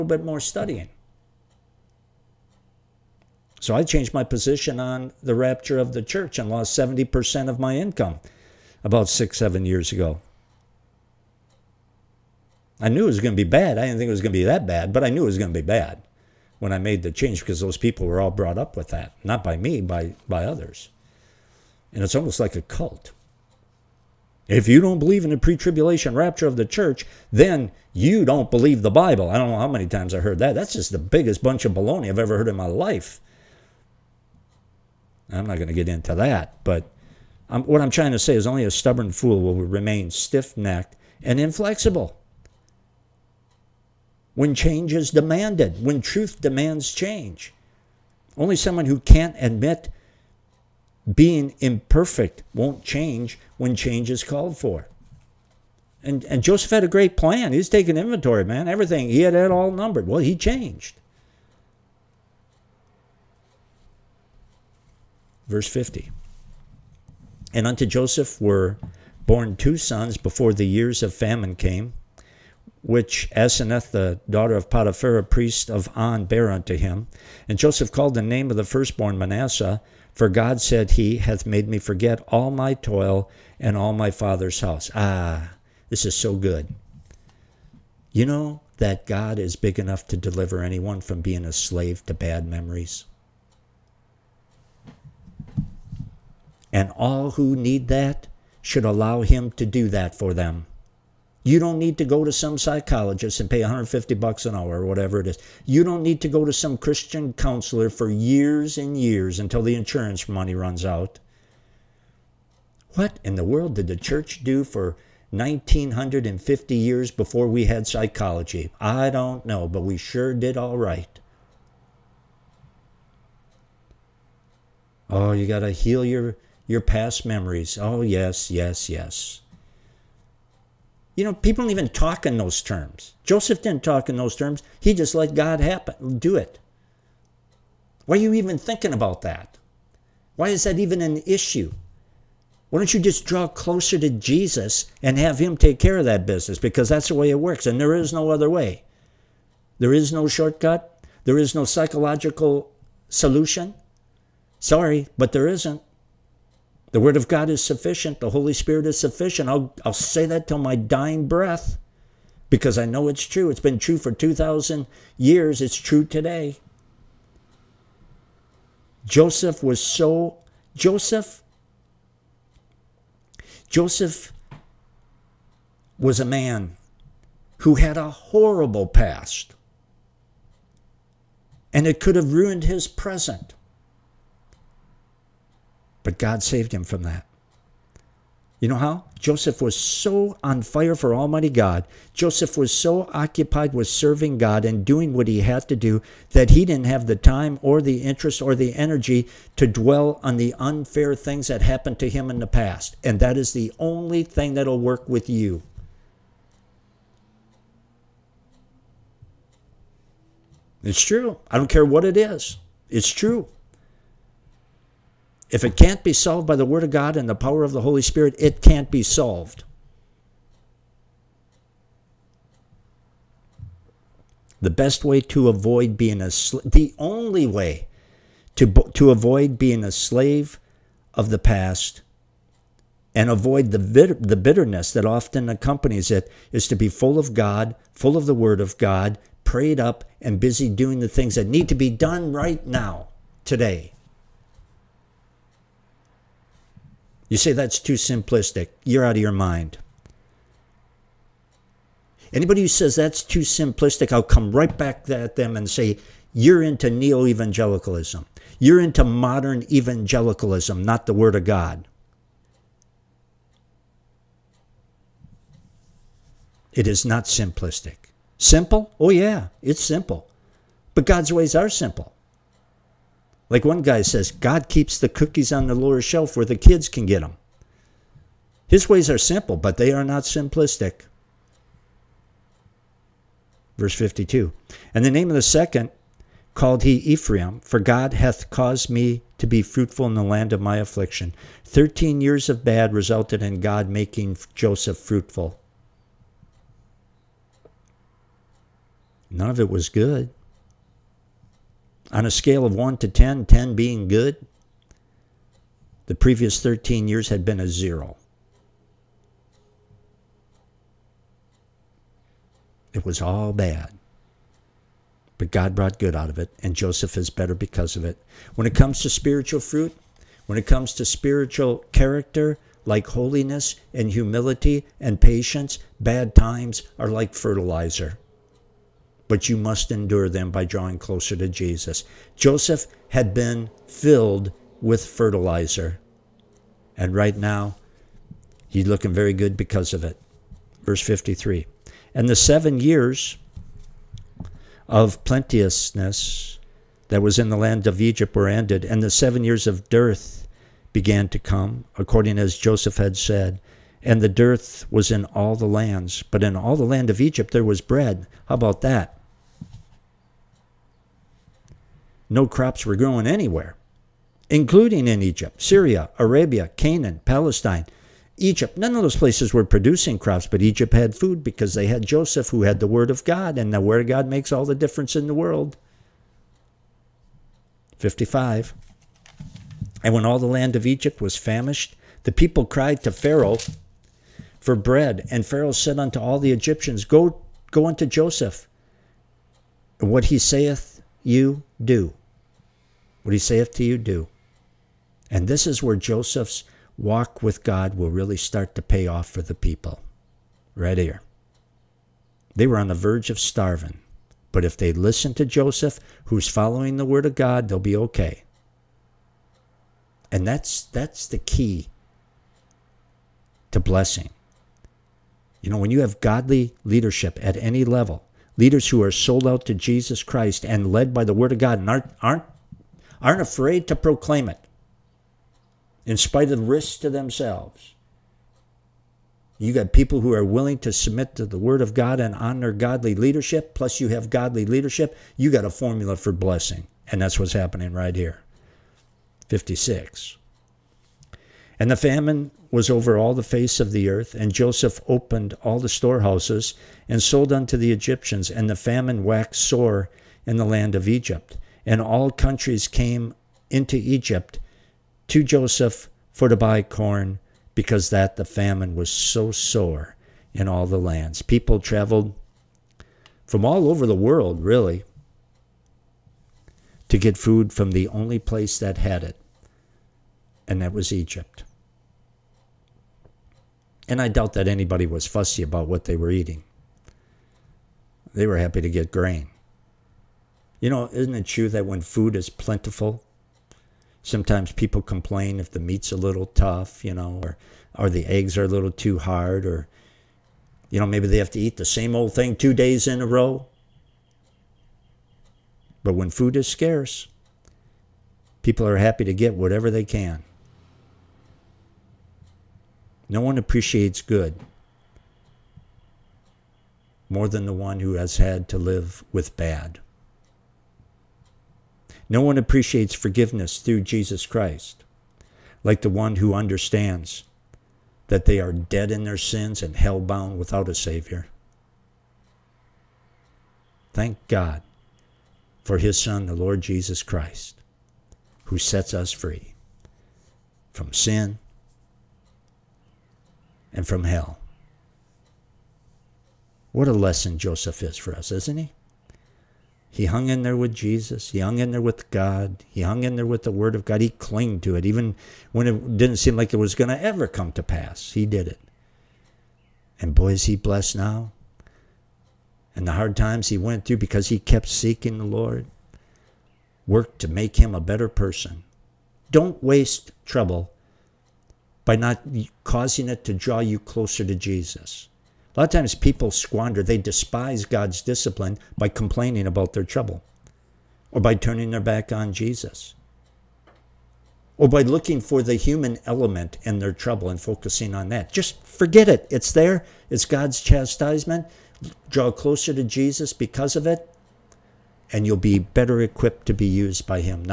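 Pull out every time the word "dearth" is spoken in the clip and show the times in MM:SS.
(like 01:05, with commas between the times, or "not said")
05:49, 05:54.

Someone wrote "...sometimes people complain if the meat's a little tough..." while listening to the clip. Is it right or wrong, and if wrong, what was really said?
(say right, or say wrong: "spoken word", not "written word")
right.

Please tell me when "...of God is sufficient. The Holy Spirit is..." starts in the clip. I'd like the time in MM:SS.
02:37.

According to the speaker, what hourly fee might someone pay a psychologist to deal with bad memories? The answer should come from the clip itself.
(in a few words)
150 bucks.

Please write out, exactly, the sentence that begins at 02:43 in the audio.
It's been true for 2,000 years.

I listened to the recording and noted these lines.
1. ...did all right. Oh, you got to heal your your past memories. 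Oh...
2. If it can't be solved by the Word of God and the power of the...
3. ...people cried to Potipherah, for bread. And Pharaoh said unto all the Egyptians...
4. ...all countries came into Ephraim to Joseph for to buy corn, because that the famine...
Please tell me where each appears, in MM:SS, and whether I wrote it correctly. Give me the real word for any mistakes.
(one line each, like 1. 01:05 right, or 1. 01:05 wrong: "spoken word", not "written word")
1. 02:00 right
2. 03:35 right
3. 06:22 wrong: "Pharaoh", not "Potipherah"
4. 07:32 wrong: "Egypt", not "Ephraim".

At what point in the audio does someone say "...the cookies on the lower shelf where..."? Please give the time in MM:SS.
04:34.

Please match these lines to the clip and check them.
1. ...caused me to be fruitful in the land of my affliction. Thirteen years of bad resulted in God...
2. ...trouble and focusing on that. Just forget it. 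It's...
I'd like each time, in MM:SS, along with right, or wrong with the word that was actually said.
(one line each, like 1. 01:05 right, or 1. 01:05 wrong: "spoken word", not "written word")
1. 04:48 right
2. 09:37 right.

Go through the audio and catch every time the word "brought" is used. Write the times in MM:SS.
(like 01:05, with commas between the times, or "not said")
00:18, 05:15.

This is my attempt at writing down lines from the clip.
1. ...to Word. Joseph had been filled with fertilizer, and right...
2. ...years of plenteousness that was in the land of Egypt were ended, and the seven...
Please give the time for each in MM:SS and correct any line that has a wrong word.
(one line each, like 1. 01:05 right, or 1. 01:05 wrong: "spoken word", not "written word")
1. 05:31 wrong: "Jesus", not "Word"
2. 05:42 right.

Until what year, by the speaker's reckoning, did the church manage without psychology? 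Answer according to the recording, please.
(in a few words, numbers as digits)
1950.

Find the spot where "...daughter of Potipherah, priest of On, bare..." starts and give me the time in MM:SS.
01:14.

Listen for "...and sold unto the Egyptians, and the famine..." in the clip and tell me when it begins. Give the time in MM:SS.
07:27.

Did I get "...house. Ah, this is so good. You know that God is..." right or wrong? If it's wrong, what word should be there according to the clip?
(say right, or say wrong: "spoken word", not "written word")
right.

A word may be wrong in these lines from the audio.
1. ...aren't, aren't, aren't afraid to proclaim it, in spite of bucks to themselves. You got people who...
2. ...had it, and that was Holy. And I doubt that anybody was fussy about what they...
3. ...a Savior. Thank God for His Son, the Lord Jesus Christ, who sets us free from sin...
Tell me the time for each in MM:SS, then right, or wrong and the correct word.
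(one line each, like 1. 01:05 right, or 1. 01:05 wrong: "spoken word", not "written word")
1. 07:01 wrong: "risks", not "bucks"
2. 07:48 wrong: "Egypt", not "Holy"
3. 08:40 right.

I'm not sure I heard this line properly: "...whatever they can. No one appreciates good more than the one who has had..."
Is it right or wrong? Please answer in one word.
right.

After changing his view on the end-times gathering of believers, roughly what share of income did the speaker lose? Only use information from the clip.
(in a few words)
70%.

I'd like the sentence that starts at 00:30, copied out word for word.
That's just the biggest bunch of baloney I've ever heard in my life.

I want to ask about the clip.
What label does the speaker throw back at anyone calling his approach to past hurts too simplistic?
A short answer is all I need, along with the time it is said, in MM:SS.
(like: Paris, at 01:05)
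neo evangelicalism, at 04:16.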